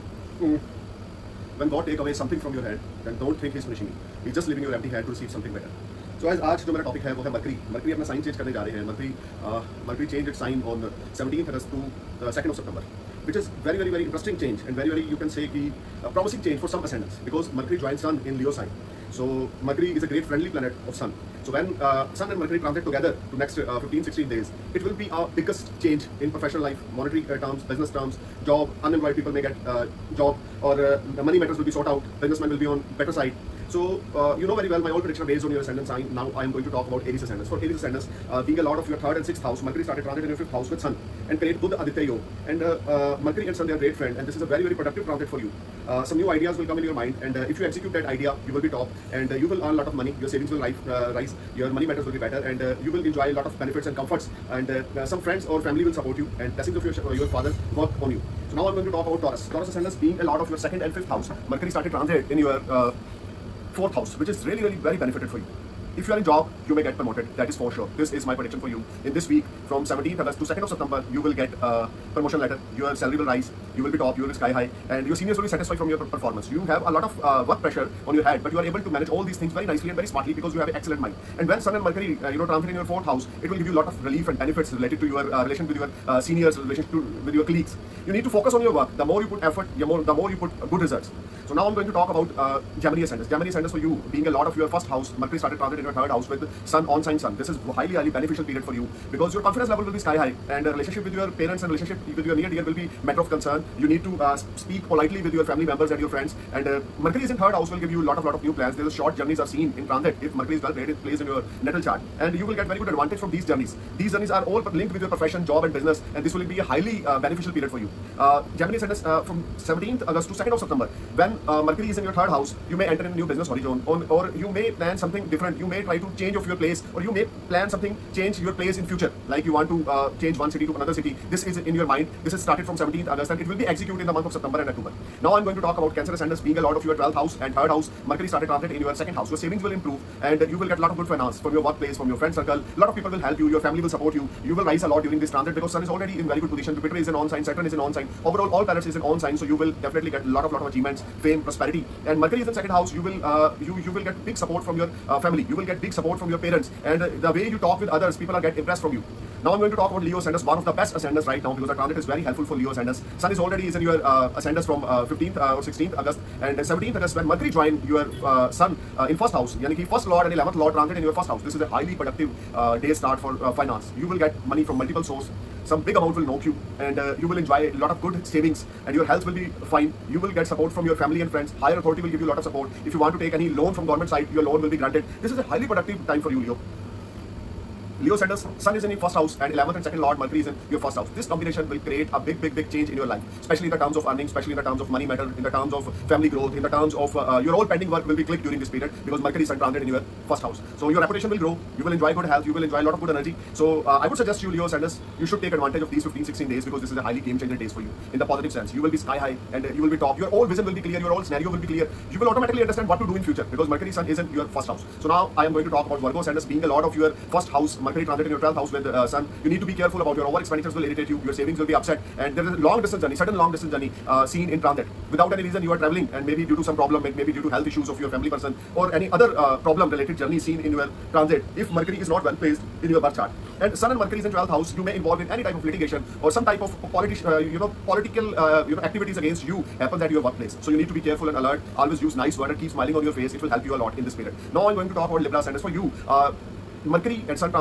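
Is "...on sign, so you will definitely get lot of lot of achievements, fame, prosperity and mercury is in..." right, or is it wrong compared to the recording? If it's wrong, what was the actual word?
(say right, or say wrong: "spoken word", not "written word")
right.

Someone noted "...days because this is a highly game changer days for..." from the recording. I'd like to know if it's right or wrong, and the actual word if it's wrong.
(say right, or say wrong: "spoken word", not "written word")
right.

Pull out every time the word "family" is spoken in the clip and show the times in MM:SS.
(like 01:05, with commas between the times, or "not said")
00:55, 01:45, 02:23, 02:35, 03:00, 03:16, 03:48.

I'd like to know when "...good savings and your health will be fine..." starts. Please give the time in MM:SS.
02:58.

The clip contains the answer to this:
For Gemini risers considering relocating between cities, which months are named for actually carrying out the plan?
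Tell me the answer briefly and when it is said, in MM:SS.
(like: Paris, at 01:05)
September and October, at 02:14.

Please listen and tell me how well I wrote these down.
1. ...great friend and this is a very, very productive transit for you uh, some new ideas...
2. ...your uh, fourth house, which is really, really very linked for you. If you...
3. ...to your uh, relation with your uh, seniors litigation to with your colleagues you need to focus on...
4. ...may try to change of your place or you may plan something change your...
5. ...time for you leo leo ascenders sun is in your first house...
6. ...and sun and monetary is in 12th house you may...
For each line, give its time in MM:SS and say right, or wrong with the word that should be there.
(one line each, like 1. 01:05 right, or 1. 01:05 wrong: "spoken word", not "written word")
1. 00:43 right
2. 01:02 wrong: "benefited", not "linked"
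3. 01:25 wrong: "relation", not "litigation"
4. 02:05 right
5. 03:06 right
6. 03:53 wrong: "mercury", not "monetary".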